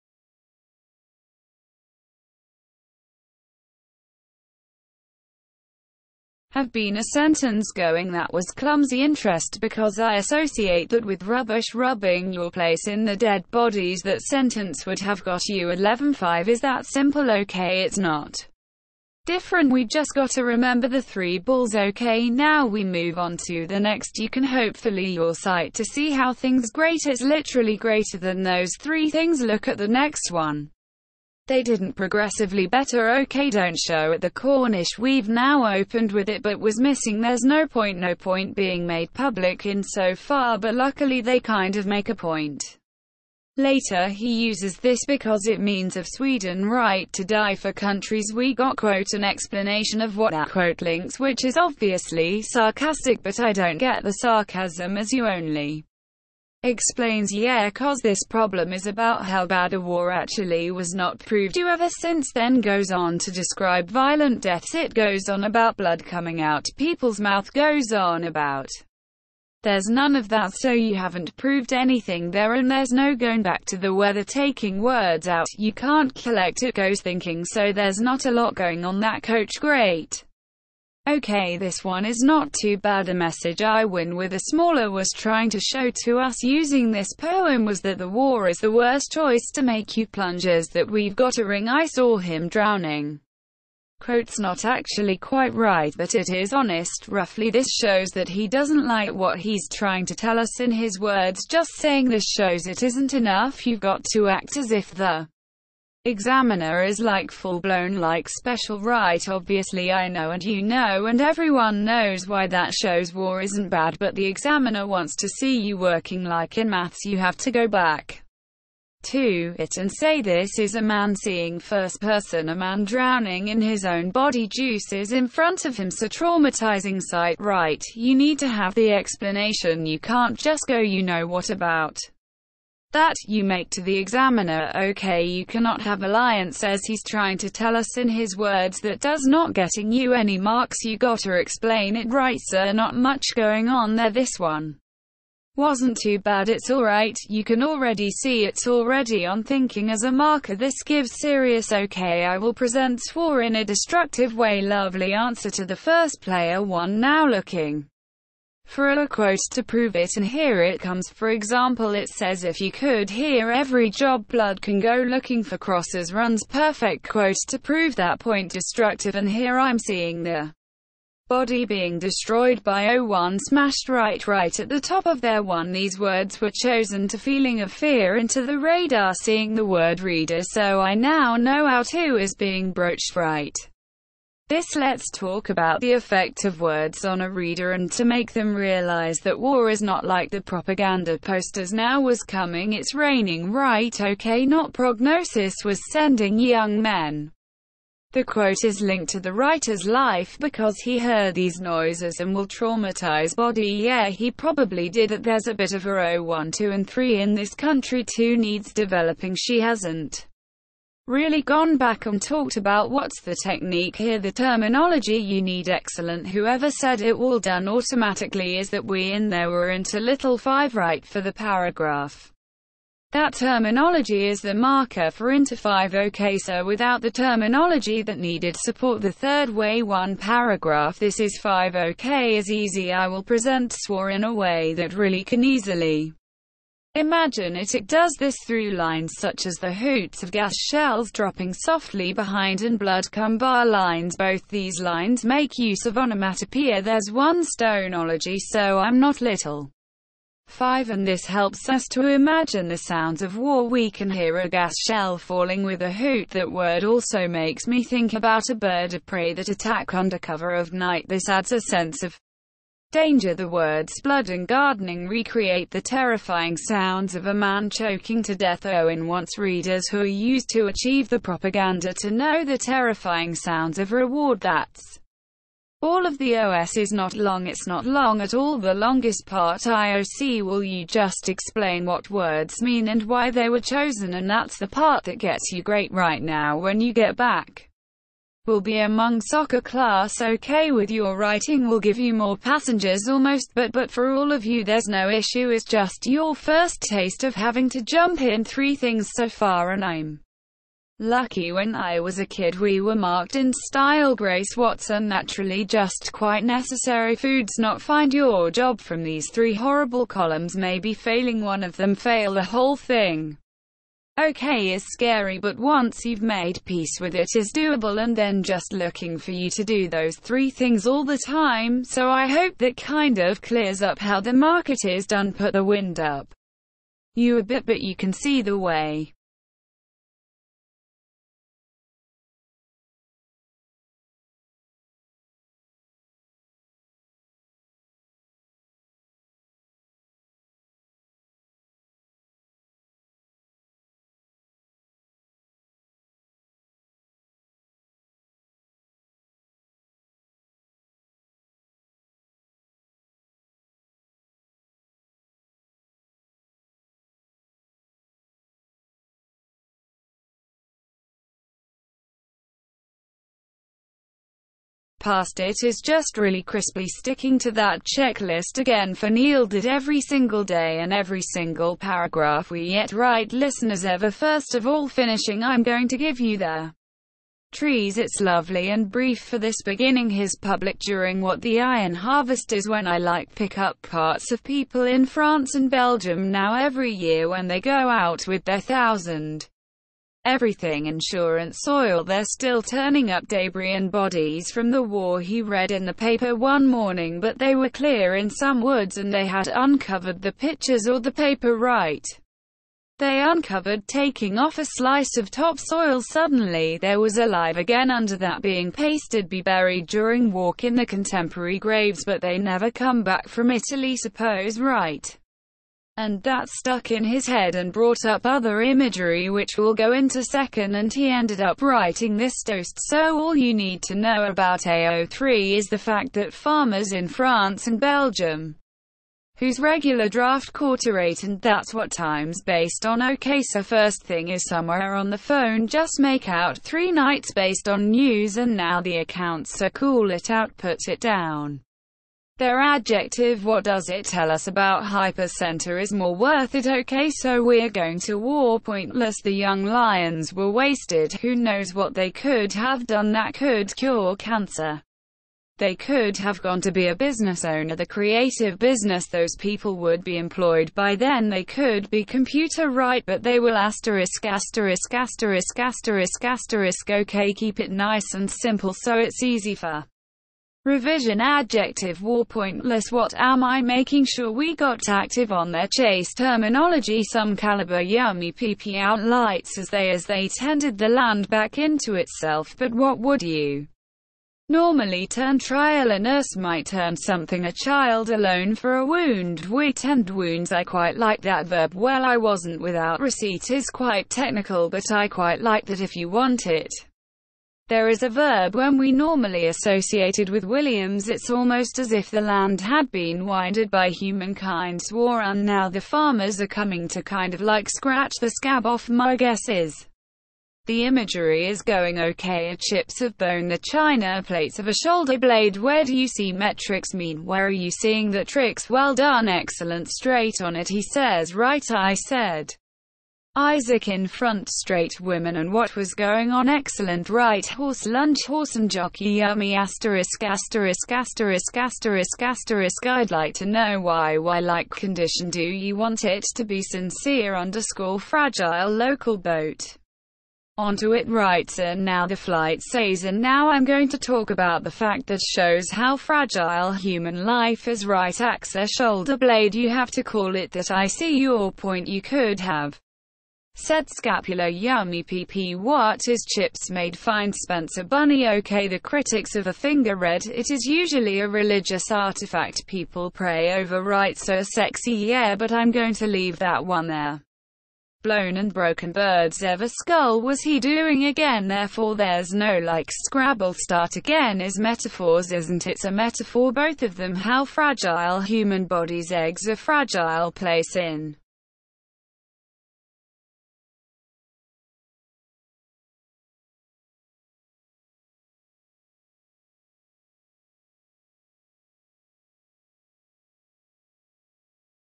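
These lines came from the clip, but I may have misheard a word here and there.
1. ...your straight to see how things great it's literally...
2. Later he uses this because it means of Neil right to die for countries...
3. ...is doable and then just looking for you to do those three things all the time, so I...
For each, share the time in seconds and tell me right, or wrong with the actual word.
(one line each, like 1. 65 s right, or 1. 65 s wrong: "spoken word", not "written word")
1. 25 s wrong: "sight", not "straight"
2. 43 s wrong: "Sweden", not "Neil"
3. 317 s right.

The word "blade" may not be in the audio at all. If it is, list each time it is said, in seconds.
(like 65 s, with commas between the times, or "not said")
515 s, 549 s.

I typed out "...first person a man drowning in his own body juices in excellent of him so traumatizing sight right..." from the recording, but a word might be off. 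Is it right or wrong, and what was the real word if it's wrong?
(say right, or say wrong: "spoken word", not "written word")
wrong: "front", not "excellent".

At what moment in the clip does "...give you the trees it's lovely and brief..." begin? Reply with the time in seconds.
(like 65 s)
375 s.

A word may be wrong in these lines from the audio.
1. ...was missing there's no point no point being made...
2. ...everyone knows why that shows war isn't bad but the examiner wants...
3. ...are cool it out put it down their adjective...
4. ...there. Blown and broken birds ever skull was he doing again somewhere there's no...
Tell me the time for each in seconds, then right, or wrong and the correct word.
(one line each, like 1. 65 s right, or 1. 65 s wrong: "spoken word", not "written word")
1. 36 s right
2. 111 s right
3. 439 s right
4. 566 s wrong: "therefore", not "somewhere".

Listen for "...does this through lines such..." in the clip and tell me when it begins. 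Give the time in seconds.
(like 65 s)
237 s.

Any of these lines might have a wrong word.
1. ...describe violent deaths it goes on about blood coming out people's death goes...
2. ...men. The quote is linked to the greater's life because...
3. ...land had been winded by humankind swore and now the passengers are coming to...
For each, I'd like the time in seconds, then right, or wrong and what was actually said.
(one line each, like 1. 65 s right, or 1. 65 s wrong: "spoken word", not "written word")
1. 63 s wrong: "mouth", not "death"
2. 196 s wrong: "writer", not "greater"
3. 502 s wrong: "farmers", not "passengers".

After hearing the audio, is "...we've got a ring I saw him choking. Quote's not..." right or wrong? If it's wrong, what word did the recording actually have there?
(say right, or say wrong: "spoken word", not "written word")
wrong: "drowning", not "choking".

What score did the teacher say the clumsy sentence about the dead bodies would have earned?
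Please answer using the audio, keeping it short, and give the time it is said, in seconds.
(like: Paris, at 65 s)
11.5, at 15 s.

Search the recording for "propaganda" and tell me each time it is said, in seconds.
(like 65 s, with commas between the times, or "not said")
190 s, 271 s.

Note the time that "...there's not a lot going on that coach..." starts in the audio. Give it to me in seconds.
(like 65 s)
77 s.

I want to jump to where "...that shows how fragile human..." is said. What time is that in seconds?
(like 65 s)
545 s.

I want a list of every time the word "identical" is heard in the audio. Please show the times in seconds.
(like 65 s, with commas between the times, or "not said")
not said.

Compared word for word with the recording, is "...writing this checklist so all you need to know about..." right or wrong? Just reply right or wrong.
wrong.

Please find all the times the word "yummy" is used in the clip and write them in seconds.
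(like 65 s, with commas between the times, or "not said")
477 s, 529 s, 554 s.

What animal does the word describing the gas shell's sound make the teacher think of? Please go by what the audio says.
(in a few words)
a bird of prey.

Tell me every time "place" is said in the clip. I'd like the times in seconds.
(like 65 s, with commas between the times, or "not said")
12 s, 580 s.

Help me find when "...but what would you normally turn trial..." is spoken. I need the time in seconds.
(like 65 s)
482 s.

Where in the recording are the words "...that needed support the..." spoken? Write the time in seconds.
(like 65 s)
228 s.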